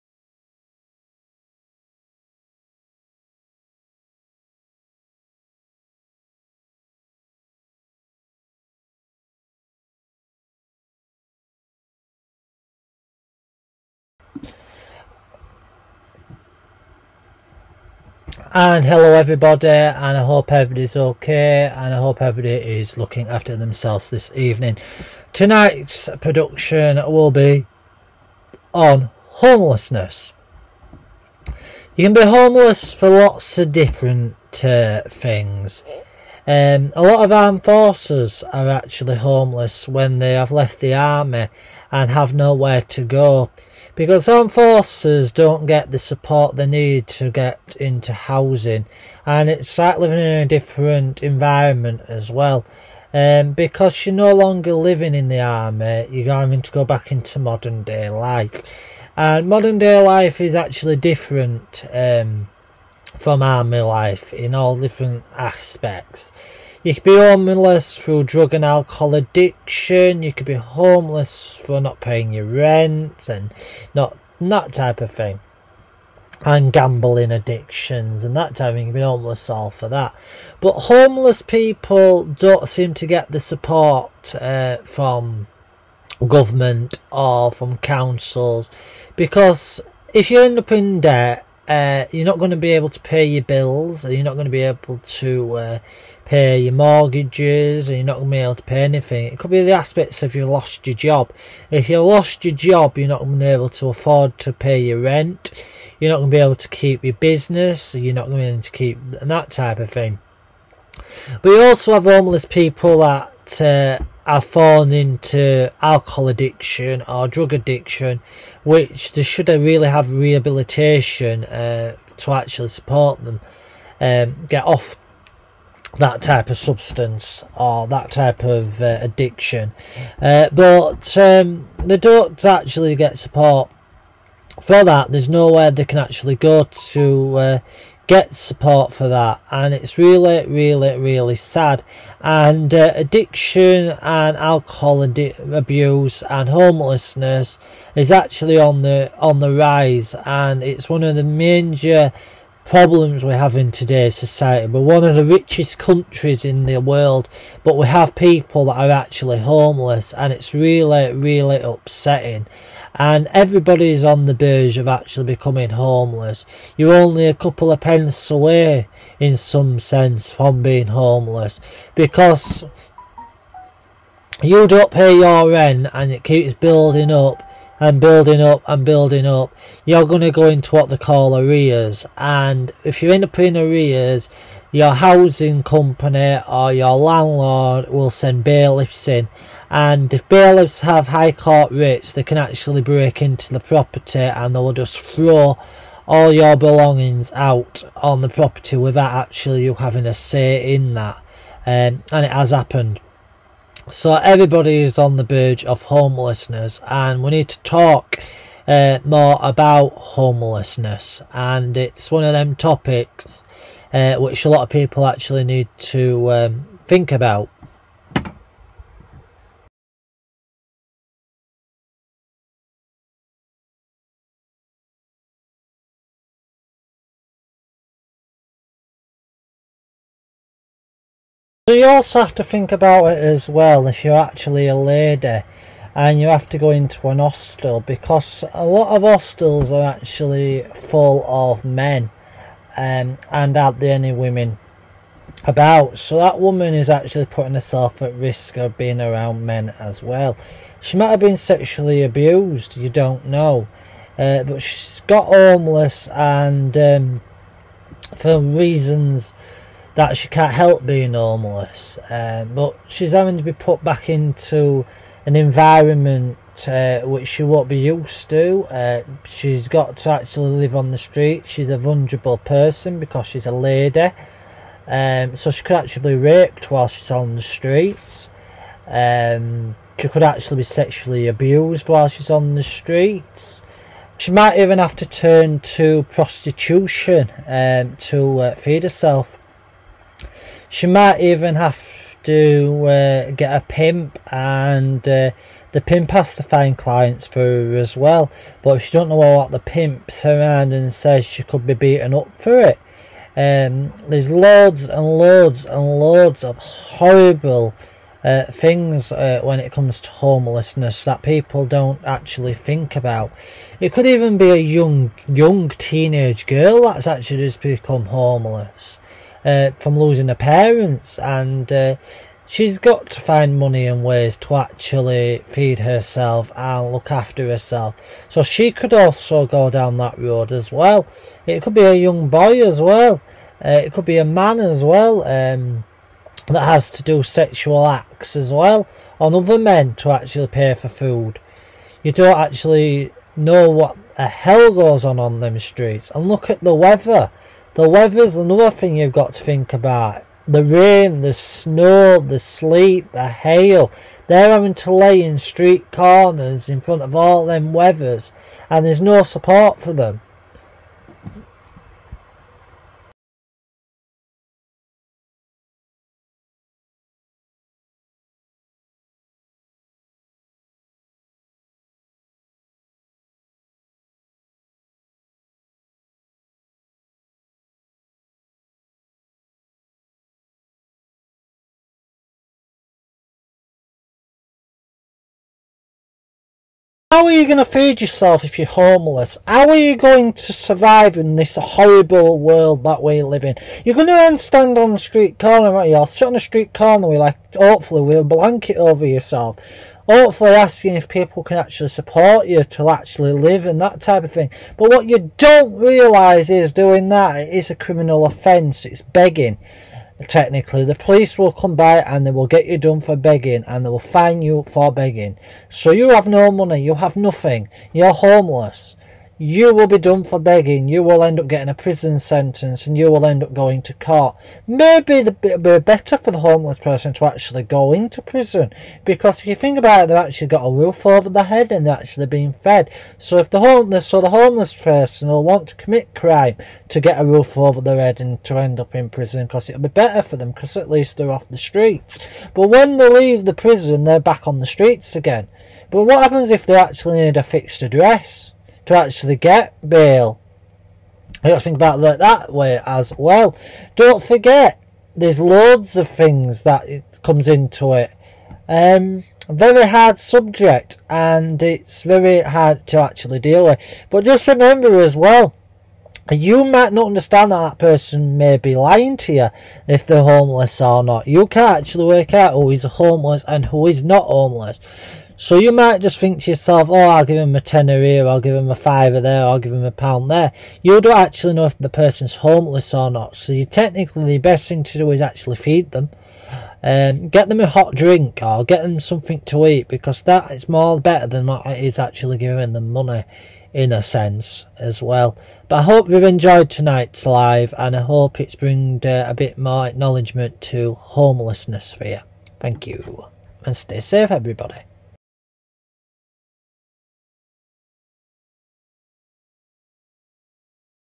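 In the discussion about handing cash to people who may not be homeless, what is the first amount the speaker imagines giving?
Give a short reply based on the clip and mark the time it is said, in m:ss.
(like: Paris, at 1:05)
A tenner, at 7:57.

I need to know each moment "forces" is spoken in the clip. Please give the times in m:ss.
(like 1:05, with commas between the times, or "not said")
0:37, 0:44.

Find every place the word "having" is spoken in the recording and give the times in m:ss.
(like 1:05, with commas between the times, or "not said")
0:56, 3:19, 4:23, 5:54.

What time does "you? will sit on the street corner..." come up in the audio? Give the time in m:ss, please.
6:35.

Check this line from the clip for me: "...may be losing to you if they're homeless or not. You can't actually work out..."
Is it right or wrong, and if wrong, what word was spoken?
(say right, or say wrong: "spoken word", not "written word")
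wrong: "lying", not "losing".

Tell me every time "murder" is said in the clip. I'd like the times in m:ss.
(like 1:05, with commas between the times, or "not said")
not said.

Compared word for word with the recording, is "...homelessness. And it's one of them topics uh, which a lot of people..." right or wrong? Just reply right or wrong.
right.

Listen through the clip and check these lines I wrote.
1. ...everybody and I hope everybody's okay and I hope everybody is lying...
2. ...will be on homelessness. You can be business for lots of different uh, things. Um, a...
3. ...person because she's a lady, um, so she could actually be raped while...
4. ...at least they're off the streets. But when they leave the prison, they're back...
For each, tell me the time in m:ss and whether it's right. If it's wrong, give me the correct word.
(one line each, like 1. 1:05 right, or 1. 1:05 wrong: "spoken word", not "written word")
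1. 0:19 wrong: "looking", not "lying"
2. 0:26 wrong: "homeless", not "business"
3. 4:32 right
4. 7:20 right.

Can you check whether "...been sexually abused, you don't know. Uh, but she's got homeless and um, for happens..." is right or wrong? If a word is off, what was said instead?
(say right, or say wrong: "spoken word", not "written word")
wrong: "reasons", not "happens".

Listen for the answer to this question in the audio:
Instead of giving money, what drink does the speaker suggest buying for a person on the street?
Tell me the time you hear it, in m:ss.
8:07.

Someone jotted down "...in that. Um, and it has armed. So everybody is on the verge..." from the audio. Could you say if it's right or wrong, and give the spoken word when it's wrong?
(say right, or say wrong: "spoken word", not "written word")
wrong: "happened", not "armed".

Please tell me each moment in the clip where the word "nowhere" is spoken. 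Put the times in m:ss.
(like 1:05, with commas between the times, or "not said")
0:42, 2:15.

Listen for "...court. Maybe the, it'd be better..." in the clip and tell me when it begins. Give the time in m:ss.
7:03.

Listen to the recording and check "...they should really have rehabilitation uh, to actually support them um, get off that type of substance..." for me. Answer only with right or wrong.
right.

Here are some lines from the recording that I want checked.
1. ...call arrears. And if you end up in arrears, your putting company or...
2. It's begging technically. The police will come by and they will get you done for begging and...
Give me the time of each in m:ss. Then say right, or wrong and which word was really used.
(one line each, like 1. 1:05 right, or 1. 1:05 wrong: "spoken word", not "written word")
1. 3:00 wrong: "housing", not "putting"
2. 6:48 right.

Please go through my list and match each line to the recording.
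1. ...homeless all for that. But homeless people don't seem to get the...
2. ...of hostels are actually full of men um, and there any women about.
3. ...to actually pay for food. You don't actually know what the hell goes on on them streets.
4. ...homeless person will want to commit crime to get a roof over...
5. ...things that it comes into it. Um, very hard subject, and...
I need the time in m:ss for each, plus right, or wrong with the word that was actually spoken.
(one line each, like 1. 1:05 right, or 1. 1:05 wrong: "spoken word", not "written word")
1. 1:19 right
2. 3:58 right
3. 5:39 right
4. 7:14 right
5. 7:36 right.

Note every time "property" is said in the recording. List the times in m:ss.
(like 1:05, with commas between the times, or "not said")
3:13, 3:18.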